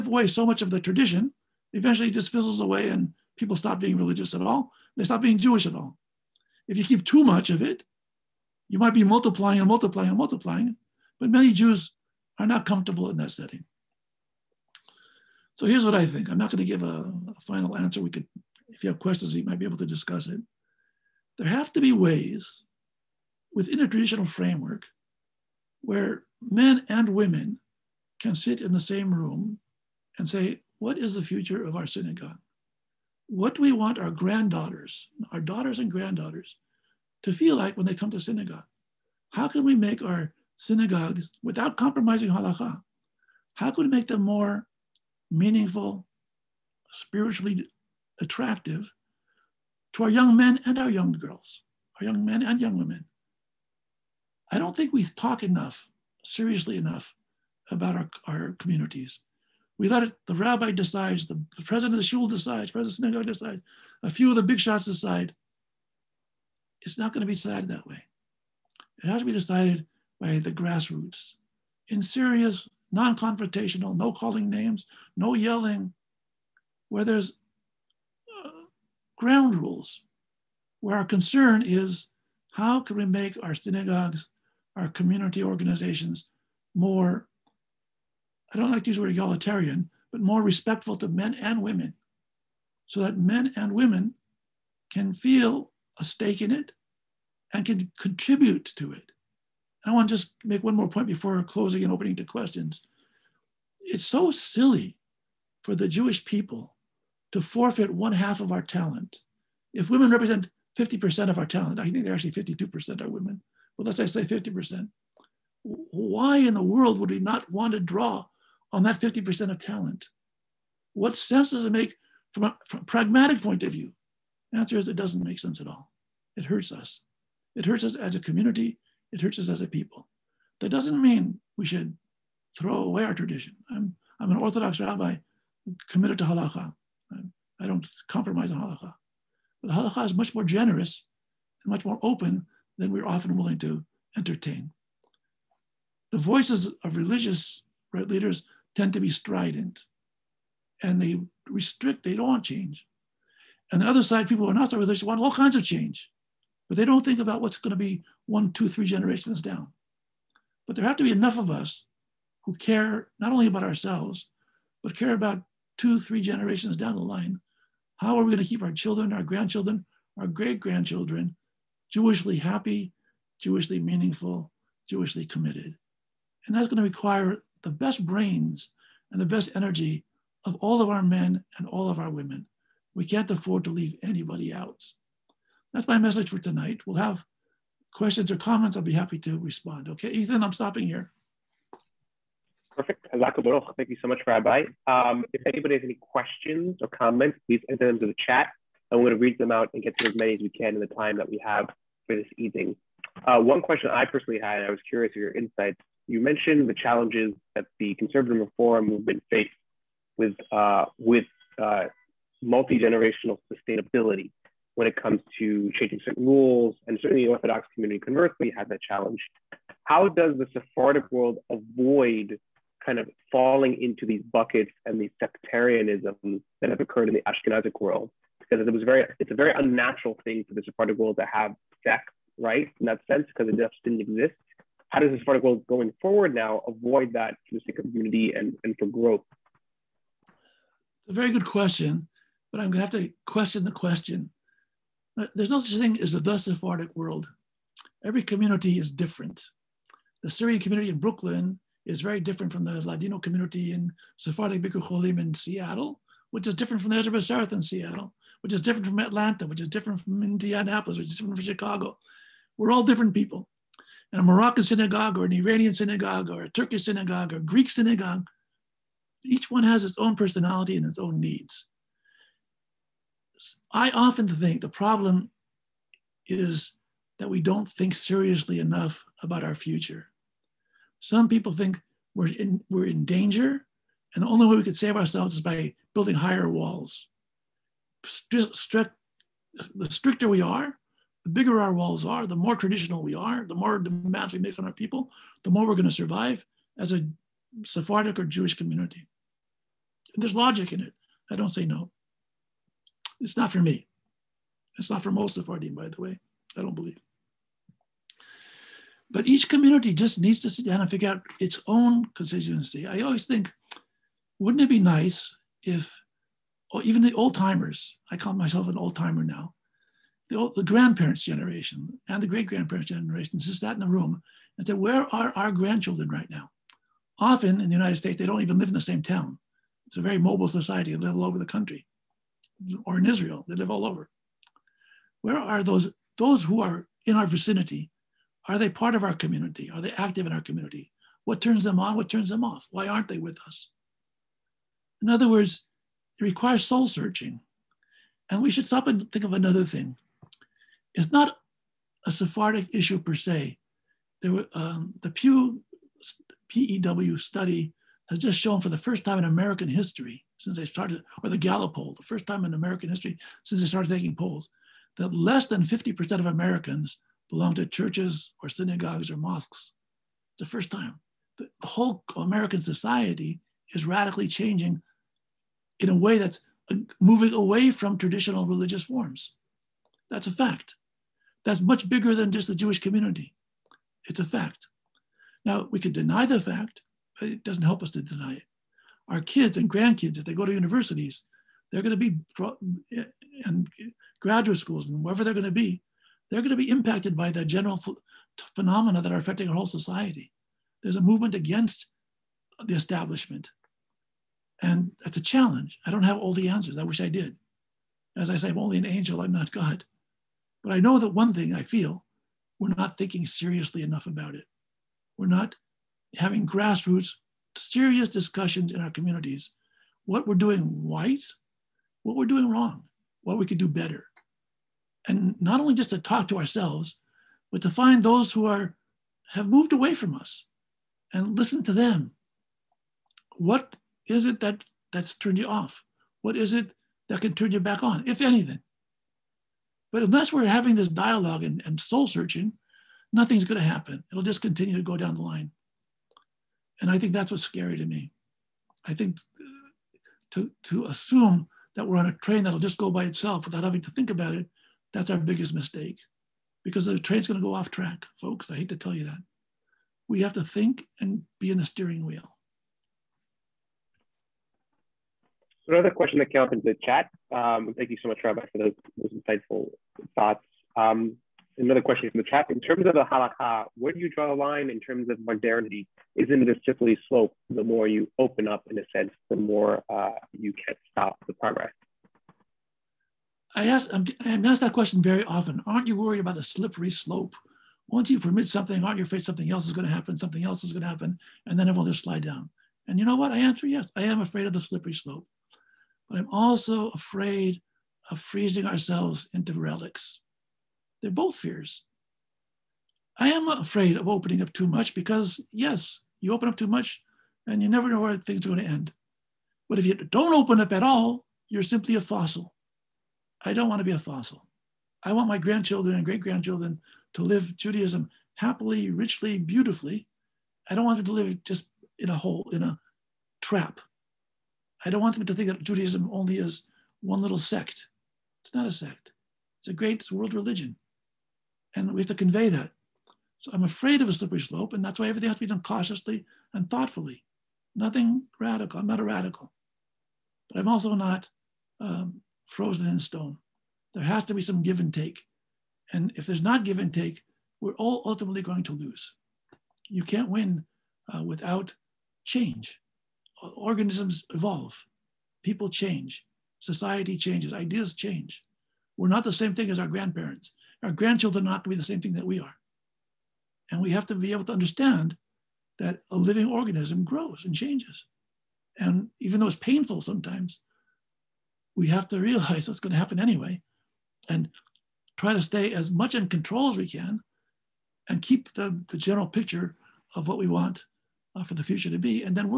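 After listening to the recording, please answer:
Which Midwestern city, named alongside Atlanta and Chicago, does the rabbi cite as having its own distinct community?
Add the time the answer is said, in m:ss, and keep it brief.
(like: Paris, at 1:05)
Indianapolis, at 4:20.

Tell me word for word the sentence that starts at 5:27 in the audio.
Often in the United States, they don't even live in the same town.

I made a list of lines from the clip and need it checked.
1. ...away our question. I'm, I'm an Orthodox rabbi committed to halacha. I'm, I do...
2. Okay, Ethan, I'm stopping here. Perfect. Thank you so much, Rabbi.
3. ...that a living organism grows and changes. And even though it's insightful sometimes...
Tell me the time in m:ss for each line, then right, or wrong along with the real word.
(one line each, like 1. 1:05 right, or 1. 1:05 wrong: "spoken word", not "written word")
1. 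2:12 wrong: "tradition", not "question"
2. 3:09 right
3. 9:25 wrong: "painful", not "insightful".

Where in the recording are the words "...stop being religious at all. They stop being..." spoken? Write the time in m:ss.
0:03.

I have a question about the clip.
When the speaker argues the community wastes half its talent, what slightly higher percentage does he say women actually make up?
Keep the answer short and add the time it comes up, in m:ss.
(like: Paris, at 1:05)
52%, at 1:52.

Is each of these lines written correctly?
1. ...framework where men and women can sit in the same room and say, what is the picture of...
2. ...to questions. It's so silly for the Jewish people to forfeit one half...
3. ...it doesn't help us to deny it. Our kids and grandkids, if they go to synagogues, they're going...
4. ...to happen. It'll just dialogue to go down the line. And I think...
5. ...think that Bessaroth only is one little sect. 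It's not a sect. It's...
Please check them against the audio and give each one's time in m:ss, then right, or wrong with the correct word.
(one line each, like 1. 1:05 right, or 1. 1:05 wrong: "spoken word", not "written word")
1. 0:24 wrong: "future", not "picture"
2. 1:42 right
3. 6:27 wrong: "universities", not "synagogues"
4. 7:23 wrong: "continue", not "dialogue"
5. 8:45 wrong: "Judaism", not "Bessaroth".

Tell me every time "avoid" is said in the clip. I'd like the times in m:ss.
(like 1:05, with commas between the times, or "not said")
3:41, 3:56.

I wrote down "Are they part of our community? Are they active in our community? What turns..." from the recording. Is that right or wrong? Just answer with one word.
right.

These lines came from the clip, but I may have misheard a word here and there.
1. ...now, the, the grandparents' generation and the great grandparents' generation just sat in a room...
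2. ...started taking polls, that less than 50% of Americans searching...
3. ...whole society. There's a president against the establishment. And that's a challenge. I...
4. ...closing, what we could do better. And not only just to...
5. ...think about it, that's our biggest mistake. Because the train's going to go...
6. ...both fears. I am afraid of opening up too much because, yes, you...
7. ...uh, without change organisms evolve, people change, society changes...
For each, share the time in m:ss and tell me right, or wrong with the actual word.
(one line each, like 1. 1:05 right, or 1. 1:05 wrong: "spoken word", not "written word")
1. 5:19 right
2. 6:03 wrong: "belong", not "searching"
3. 6:39 wrong: "movement", not "president"
4. 7:02 wrong: "wrong", not "closing"
5. 7:33 right
6. 8:21 right
7. 9:11 right.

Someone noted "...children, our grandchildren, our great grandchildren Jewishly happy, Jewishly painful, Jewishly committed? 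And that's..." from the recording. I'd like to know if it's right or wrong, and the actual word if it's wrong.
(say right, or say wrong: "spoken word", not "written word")
wrong: "meaningful", not "painful".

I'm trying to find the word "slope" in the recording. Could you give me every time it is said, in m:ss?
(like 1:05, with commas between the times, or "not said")
7:57, 8:06, 8:14, 8:54.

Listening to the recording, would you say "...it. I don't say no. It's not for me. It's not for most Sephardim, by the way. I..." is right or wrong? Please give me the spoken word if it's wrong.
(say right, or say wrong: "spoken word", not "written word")
right.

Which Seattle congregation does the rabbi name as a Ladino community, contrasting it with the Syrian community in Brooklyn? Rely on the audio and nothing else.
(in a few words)
Sephardic Bikur Cholim.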